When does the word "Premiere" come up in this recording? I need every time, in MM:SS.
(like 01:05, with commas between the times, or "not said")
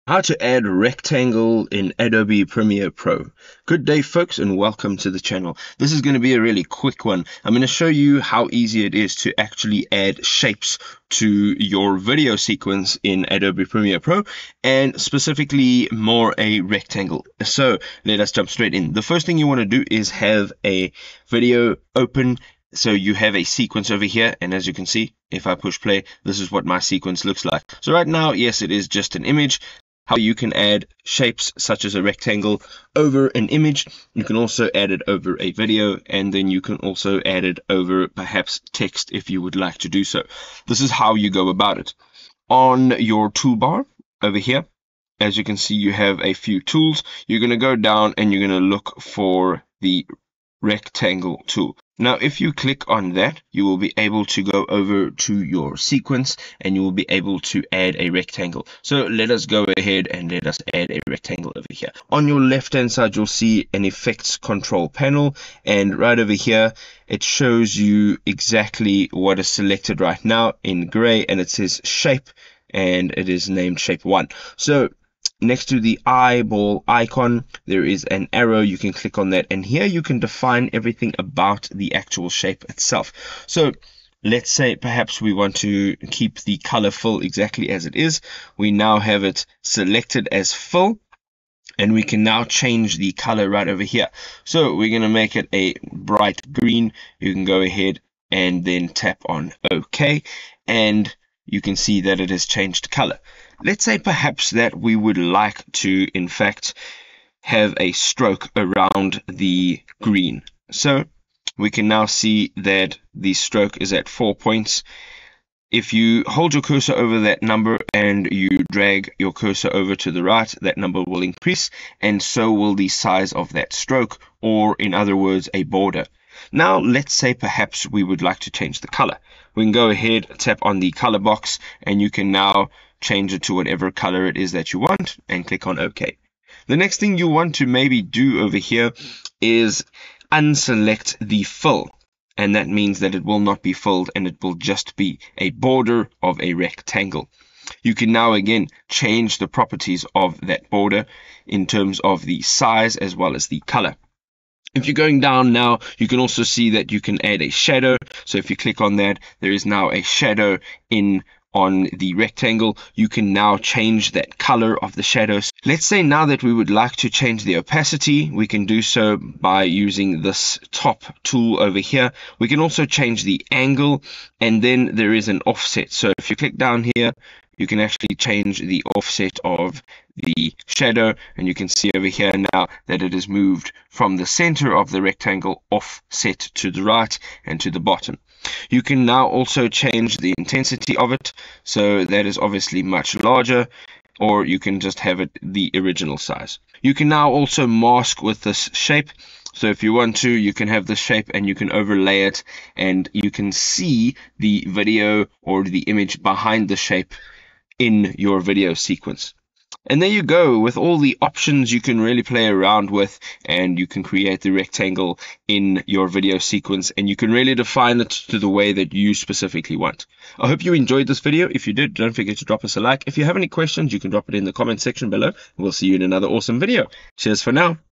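00:02, 00:13.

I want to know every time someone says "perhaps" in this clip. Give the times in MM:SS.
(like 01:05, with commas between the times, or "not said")
00:38, 01:24, 01:43, 02:07.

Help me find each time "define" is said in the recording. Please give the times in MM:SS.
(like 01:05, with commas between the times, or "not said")
01:20, 03:37.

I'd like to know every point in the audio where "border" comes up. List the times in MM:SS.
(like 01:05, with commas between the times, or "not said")
02:05, 02:25, 02:30.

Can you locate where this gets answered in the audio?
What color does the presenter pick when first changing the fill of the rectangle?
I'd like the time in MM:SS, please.
01:35.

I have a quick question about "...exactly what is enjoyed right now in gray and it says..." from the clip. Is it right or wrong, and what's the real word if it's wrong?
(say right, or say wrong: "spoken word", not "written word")
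wrong: "selected", not "enjoyed".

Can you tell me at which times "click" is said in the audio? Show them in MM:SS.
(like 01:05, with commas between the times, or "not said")
00:52, 01:18, 02:15, 02:38, 02:56.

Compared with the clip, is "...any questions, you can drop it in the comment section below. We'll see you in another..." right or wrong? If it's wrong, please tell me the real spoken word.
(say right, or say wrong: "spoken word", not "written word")
right.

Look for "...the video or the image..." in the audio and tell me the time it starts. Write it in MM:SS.
03:24.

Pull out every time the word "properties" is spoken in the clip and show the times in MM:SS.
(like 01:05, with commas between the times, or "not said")
02:29.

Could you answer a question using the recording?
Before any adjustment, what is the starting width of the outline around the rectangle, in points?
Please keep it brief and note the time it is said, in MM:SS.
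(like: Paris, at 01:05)
4, at 01:54.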